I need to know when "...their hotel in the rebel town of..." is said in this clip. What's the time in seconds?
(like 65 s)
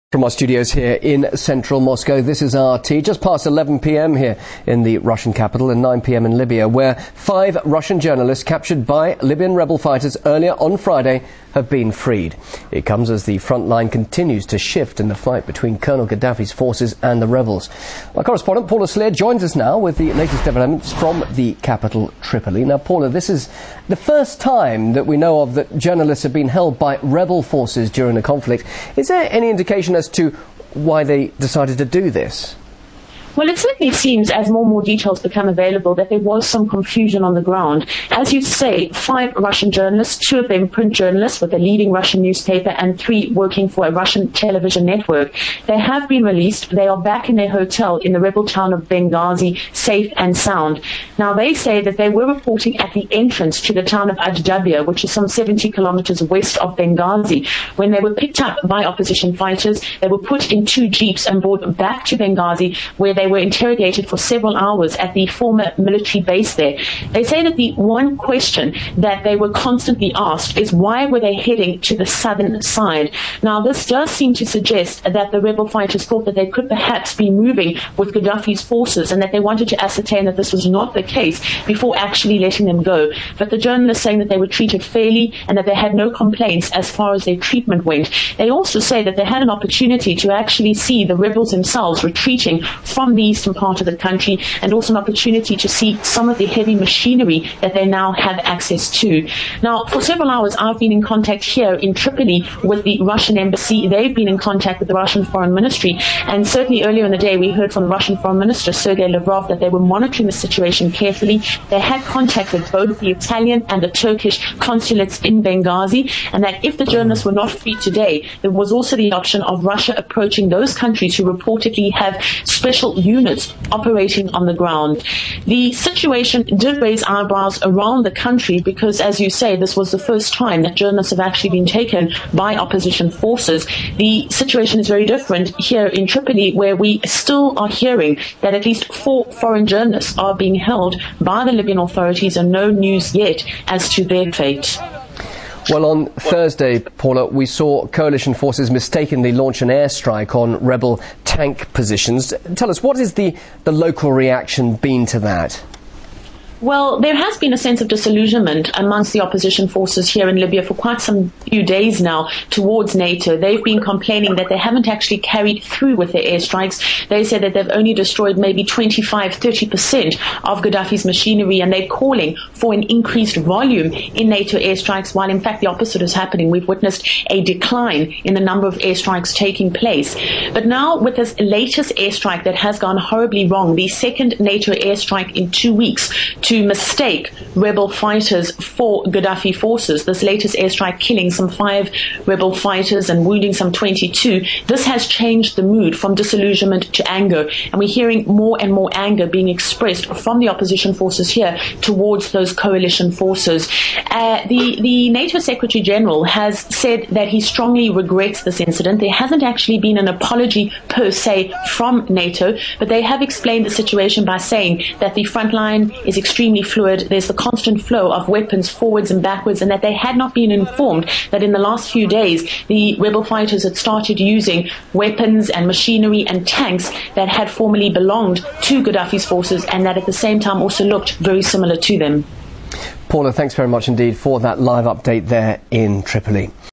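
47 s.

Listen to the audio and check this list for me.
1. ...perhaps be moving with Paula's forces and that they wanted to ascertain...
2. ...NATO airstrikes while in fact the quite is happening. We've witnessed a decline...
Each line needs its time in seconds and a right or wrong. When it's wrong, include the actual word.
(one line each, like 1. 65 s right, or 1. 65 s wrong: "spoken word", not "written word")
1. 76 s wrong: "Gaddafi", not "Paula"
2. 174 s wrong: "opposite", not "quite".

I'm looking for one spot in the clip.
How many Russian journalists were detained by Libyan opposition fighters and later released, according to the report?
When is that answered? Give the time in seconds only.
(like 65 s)
38 s.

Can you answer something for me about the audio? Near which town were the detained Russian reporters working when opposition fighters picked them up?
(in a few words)
Ajdabiya.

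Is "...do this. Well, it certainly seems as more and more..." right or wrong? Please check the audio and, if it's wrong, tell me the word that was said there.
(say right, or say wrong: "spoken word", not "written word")
right.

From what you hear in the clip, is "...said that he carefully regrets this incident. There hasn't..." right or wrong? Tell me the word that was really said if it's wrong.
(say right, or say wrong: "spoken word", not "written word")
wrong: "strongly", not "carefully".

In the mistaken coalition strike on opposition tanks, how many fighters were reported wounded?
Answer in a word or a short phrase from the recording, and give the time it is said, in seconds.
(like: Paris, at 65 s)
22, at 193 s.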